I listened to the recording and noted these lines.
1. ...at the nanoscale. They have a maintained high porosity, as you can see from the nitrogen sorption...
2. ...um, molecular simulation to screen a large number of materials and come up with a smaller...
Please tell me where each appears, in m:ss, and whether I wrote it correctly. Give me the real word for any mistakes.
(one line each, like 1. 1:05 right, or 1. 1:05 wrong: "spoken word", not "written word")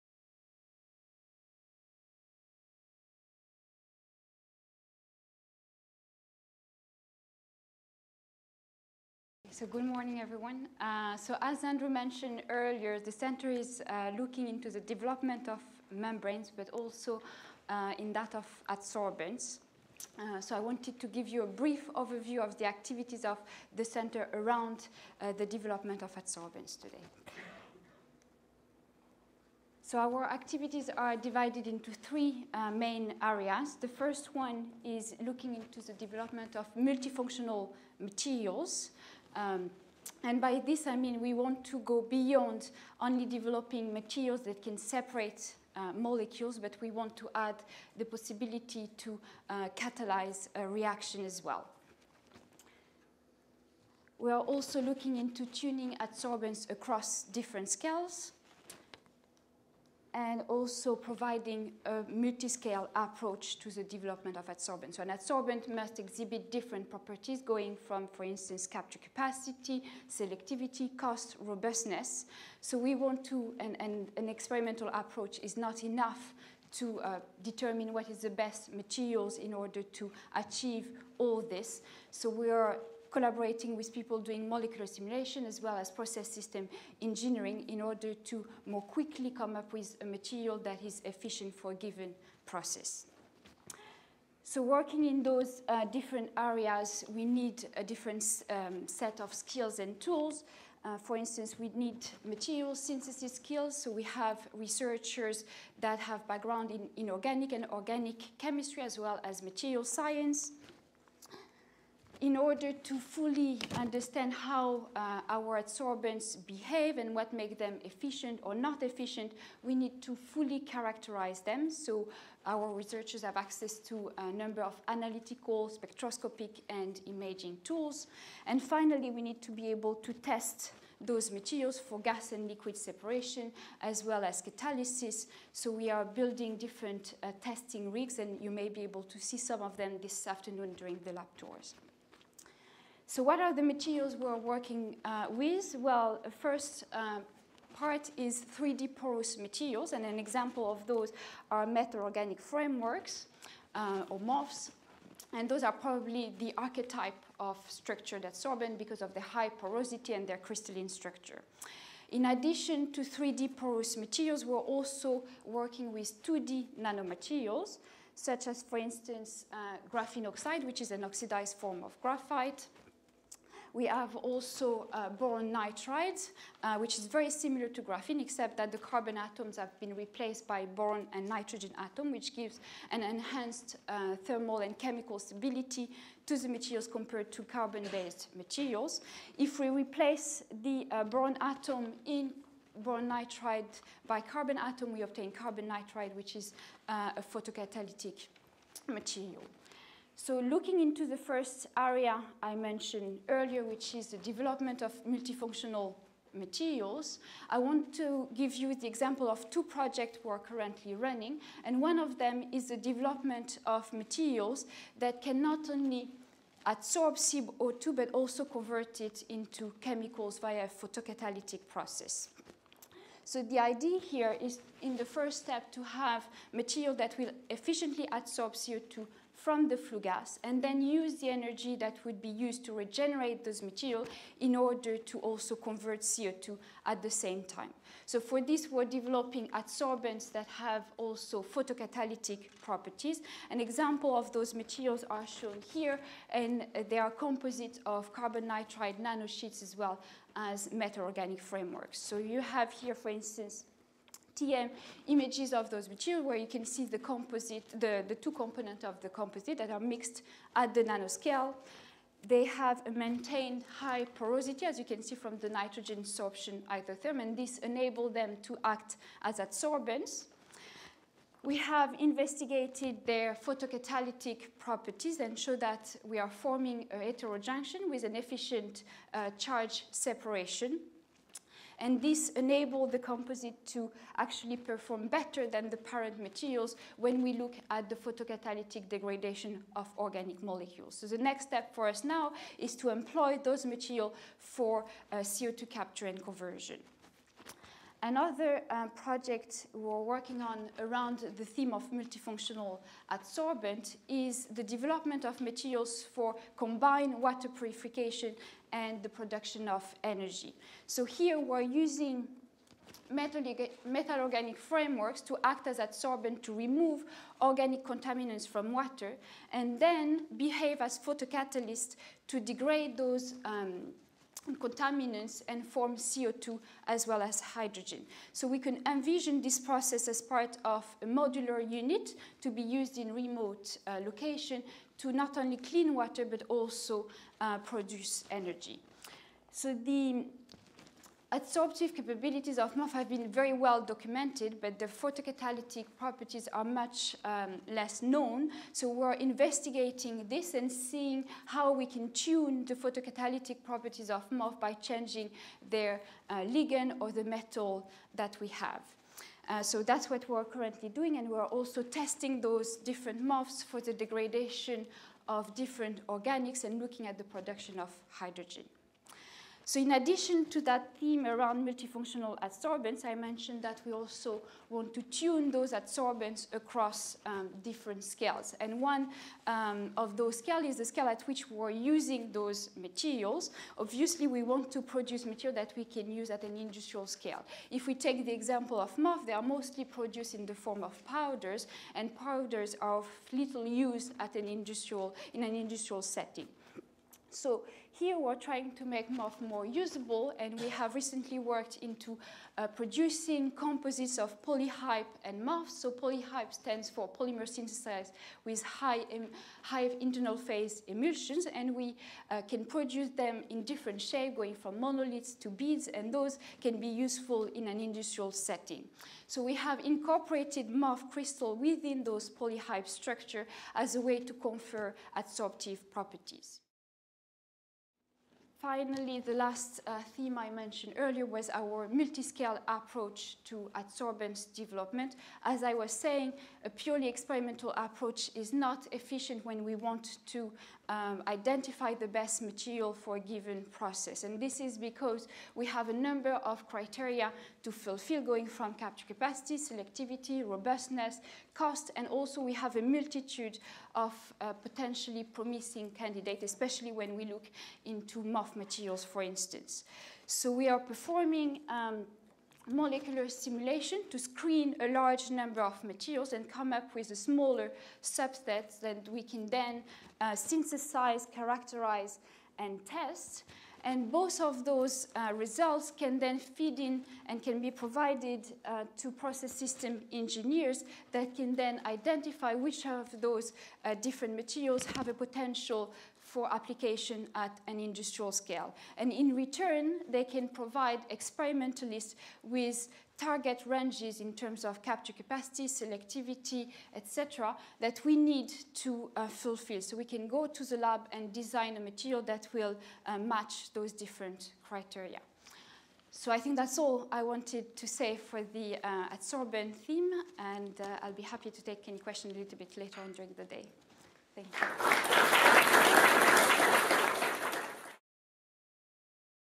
1. 4:20 right
2. 7:41 right.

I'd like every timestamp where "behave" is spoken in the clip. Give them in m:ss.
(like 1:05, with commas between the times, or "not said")
1:56, 5:20.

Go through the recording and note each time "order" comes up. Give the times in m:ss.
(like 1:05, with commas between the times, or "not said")
1:19, 1:27, 1:52, 3:54.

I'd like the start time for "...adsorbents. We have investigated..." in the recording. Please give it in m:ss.
4:29.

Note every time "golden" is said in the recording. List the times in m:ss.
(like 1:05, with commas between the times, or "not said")
not said.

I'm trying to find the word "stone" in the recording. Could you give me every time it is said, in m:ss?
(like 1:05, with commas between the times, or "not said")
not said.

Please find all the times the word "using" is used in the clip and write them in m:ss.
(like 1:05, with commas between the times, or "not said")
5:11, 6:21.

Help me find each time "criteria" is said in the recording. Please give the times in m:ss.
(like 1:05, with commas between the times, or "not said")
7:26, 8:24.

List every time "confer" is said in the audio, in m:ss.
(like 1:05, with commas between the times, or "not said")
7:04.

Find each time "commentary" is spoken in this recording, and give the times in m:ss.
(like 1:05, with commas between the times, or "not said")
not said.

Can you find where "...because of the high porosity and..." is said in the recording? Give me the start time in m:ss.
2:38.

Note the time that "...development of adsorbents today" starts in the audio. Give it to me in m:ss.
0:25.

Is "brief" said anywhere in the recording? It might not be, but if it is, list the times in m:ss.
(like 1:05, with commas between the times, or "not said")
0:21.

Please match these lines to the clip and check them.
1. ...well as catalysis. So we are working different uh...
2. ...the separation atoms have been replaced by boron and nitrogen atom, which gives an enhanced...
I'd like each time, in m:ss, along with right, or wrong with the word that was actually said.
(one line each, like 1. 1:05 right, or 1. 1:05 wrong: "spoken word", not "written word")
1. 2:14 wrong: "building", not "working"
2. 2:58 wrong: "carbon", not "separation".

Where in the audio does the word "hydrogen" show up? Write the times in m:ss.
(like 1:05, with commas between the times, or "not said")
5:27, 6:08.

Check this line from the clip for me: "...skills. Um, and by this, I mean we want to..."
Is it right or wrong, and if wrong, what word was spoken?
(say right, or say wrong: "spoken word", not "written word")
wrong: "materials", not "skills".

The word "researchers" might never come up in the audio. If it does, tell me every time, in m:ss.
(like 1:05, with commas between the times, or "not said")
1:44, 2:02.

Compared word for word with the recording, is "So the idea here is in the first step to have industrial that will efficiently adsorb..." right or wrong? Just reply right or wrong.
wrong.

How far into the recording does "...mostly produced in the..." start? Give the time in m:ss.
6:29.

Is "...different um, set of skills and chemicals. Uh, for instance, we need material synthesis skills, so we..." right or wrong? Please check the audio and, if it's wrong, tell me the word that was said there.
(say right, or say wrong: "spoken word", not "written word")
wrong: "tools", not "chemicals".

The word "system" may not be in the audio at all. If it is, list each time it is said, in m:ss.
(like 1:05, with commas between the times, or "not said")
1:26, 7:59.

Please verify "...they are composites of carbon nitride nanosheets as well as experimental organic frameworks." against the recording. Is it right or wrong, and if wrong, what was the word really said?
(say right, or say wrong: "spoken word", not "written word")
wrong: "metal", not "experimental".